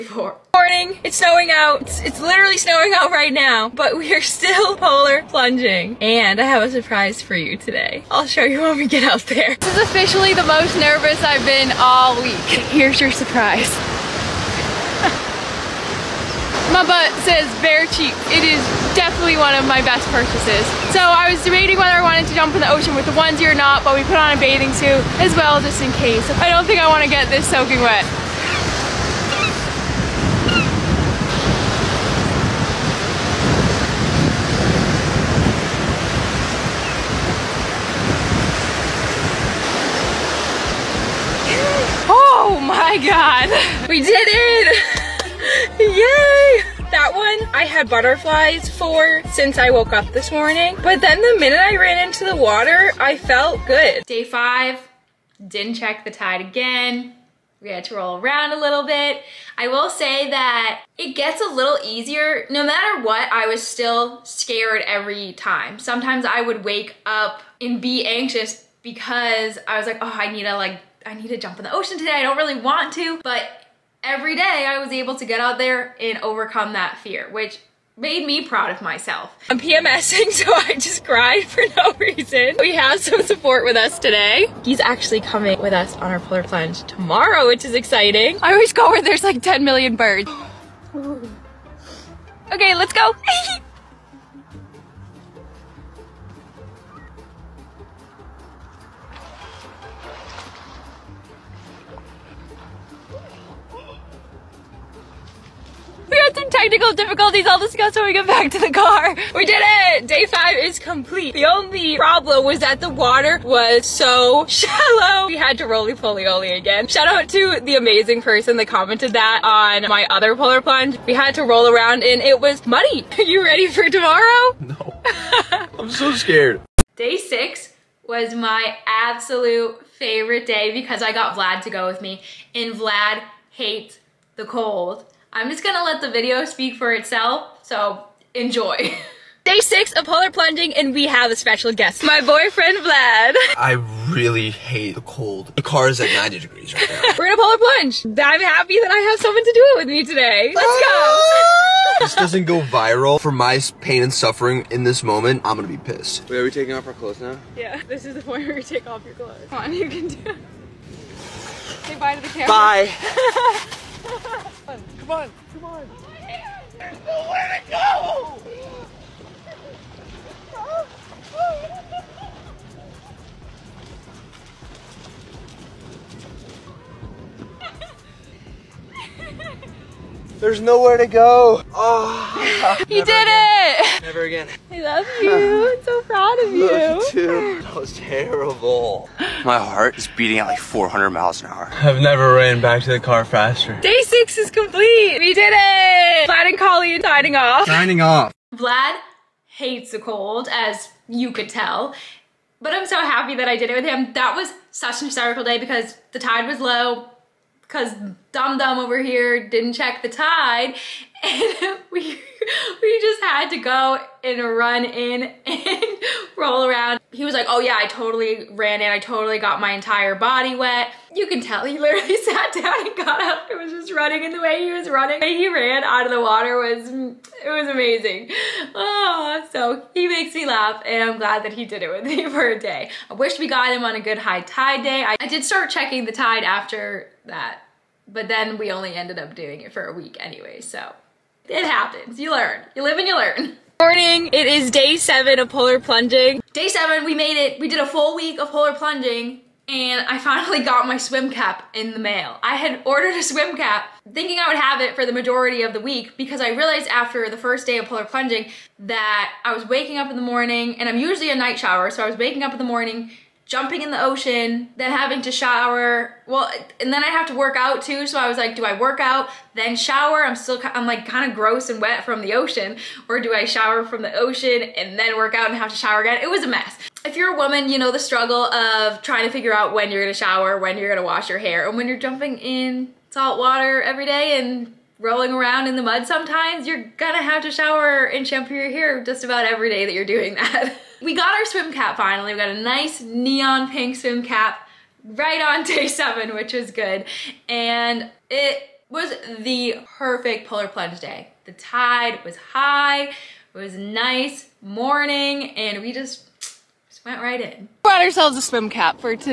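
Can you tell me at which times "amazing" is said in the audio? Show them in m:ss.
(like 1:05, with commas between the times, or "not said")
1:57, 3:47.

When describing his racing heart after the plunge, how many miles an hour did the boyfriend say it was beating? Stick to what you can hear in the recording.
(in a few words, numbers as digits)
400.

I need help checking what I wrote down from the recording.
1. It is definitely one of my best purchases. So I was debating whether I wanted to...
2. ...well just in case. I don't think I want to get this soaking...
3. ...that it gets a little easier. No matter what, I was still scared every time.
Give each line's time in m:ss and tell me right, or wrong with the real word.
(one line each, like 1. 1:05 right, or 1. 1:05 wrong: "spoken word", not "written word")
1. 0:18 right
2. 0:25 right
3. 1:00 right.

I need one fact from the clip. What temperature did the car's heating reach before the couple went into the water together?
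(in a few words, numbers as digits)
90 degrees.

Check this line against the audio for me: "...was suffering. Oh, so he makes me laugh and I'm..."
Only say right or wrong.
wrong.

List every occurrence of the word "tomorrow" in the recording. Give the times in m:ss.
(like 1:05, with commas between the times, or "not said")
1:26, 2:03.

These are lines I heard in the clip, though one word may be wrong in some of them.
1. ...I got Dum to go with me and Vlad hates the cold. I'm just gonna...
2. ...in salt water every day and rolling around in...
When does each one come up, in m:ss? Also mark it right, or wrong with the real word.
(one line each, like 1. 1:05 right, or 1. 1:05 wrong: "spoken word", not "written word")
1. 2:11 wrong: "Vlad", not "Dum"
2. 4:42 right.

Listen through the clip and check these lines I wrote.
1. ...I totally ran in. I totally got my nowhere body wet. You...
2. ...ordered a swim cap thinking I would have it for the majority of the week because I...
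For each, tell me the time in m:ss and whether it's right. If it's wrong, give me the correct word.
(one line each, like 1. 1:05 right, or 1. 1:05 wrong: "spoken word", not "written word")
1. 3:37 wrong: "entire", not "nowhere"
2. 4:12 right.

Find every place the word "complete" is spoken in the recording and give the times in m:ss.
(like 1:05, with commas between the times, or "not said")
1:50, 3:14.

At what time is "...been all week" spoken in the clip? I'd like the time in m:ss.
0:11.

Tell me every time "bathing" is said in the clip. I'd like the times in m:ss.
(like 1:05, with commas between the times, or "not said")
0:24.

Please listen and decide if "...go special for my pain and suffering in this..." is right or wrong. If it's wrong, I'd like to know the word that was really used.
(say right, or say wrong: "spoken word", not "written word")
wrong: "viral", not "special".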